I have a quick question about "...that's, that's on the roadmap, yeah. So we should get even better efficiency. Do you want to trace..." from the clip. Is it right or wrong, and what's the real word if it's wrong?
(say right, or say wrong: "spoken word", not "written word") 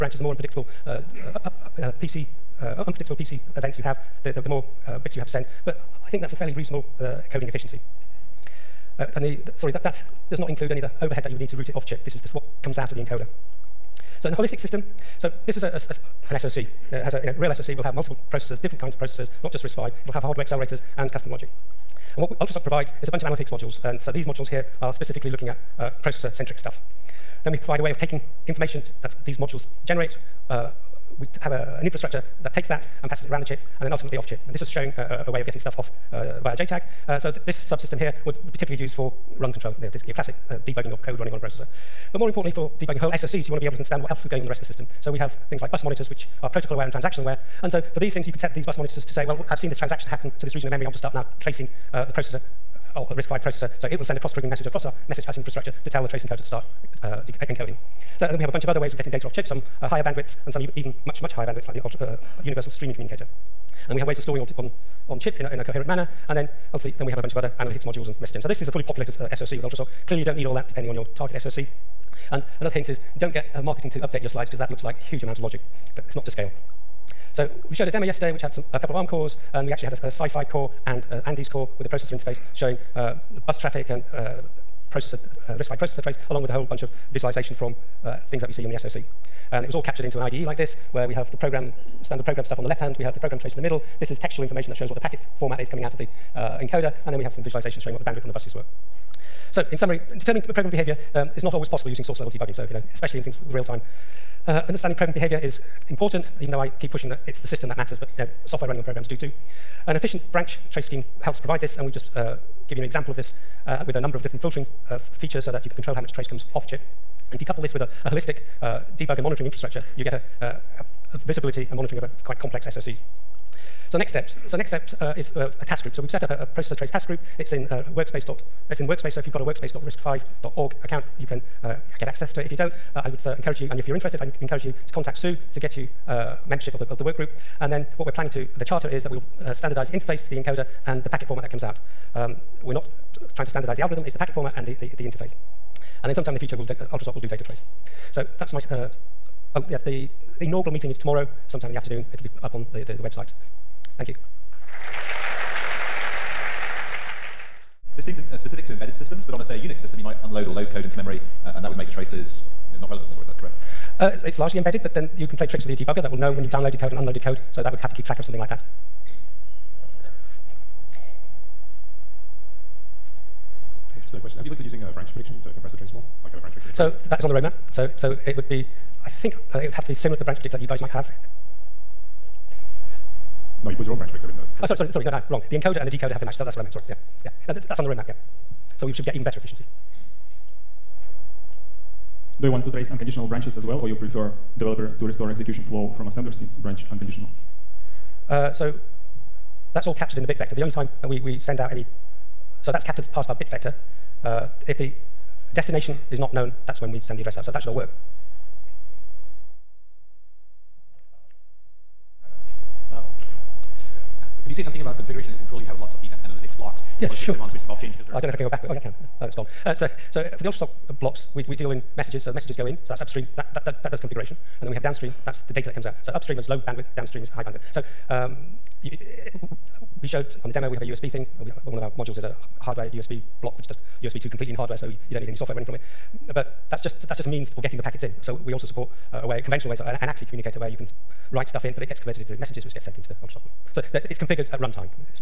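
right.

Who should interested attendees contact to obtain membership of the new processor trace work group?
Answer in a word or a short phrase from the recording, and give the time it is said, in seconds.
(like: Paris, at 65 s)
Sue, at 135 s.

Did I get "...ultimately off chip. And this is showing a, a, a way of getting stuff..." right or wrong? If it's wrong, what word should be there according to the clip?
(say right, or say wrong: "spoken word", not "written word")
right.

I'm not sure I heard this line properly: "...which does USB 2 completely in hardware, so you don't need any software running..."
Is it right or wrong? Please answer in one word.
right.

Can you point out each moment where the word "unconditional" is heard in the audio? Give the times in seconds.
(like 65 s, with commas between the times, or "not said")
192 s, 196 s.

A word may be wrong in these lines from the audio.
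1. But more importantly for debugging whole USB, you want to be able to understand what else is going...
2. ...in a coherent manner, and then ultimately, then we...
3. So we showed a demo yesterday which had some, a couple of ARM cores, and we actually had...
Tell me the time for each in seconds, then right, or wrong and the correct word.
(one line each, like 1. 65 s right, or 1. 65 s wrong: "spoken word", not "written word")
1. 42 s wrong: "SOCs", not "USB"
2. 65 s right
3. 77 s right.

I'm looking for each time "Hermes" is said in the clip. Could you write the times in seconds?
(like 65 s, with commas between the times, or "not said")
not said.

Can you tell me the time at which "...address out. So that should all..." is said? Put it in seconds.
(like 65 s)
207 s.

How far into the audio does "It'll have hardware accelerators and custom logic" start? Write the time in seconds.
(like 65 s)
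20 s.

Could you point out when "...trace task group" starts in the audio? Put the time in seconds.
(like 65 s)
126 s.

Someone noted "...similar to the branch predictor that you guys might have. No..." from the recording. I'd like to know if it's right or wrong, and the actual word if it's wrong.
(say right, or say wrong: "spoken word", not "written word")
right.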